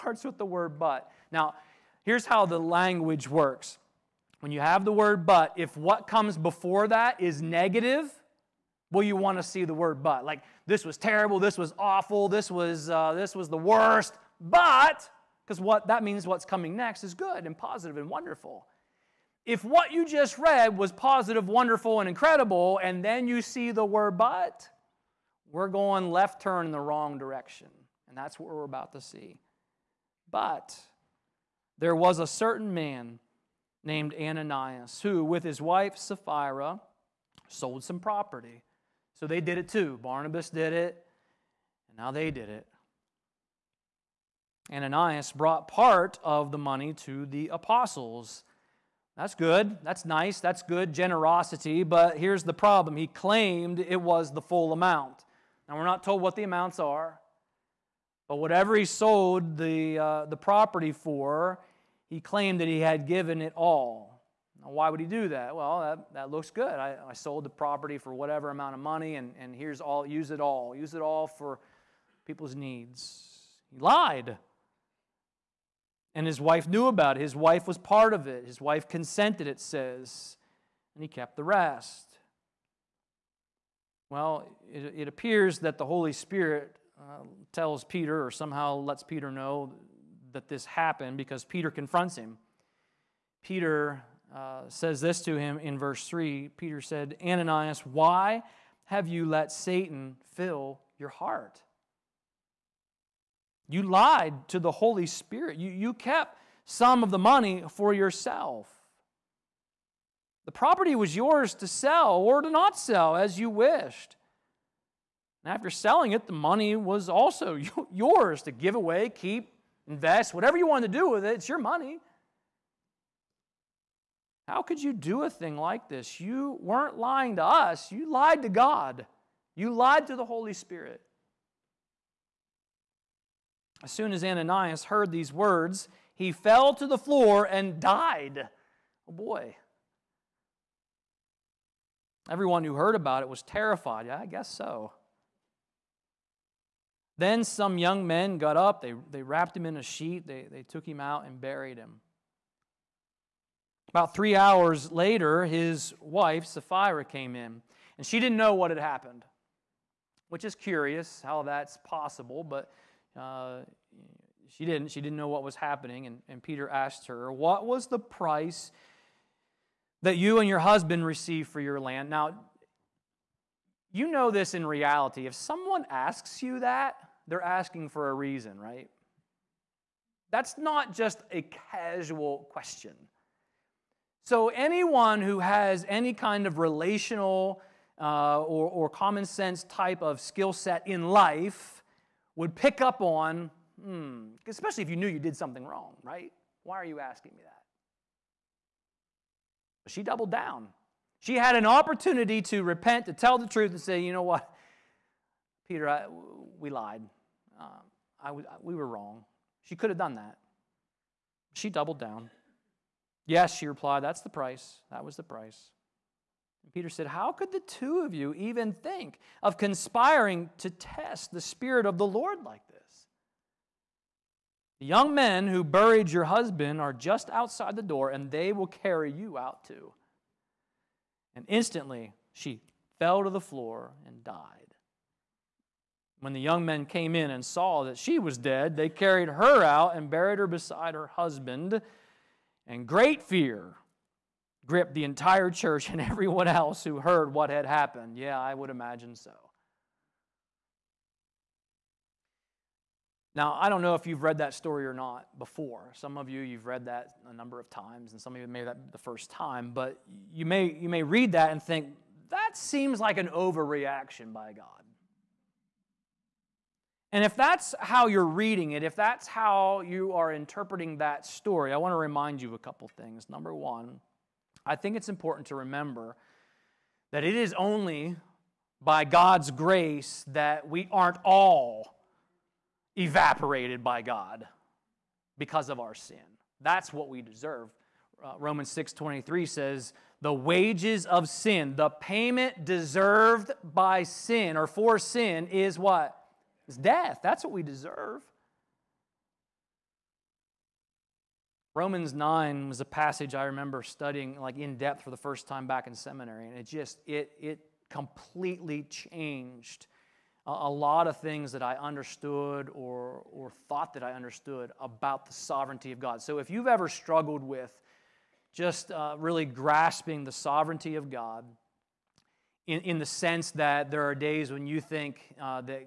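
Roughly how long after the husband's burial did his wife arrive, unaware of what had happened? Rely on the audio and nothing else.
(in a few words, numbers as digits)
3 hours.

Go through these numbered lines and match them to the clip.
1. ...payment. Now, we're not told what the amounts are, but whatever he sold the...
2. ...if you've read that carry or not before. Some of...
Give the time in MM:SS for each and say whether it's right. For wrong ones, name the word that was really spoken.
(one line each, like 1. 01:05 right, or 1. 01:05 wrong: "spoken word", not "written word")
1. 00:54 wrong: "amount", not "payment"
2. 04:13 wrong: "story", not "carry".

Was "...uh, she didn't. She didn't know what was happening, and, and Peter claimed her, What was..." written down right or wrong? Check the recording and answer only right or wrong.
wrong.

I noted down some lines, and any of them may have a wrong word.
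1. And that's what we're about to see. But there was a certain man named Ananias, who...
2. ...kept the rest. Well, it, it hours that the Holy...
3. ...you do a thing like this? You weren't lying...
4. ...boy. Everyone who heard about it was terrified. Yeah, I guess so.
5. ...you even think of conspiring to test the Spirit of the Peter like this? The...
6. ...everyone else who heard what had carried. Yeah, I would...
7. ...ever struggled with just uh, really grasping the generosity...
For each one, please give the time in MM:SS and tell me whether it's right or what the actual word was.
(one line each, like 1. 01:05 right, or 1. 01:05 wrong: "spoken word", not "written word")
1. 00:28 right
2. 01:21 wrong: "appears", not "hours"
3. 02:04 right
4. 02:19 right
5. 03:38 wrong: "Lord", not "Peter"
6. 04:06 wrong: "happened", not "carried"
7. 05:16 wrong: "sovereignty", not "generosity".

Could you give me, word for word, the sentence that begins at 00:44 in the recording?
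Ananias brought part of the money to the apostles.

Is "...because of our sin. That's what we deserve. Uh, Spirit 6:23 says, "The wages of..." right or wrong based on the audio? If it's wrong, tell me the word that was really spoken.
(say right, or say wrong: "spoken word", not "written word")
wrong: "Romans", not "Spirit".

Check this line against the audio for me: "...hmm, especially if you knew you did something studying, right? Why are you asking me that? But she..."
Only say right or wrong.
wrong.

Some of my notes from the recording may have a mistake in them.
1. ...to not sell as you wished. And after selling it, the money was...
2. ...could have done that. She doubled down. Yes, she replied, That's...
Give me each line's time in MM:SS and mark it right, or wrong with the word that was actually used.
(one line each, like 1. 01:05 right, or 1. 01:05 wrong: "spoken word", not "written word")
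1. 01:52 right
2. 03:29 right.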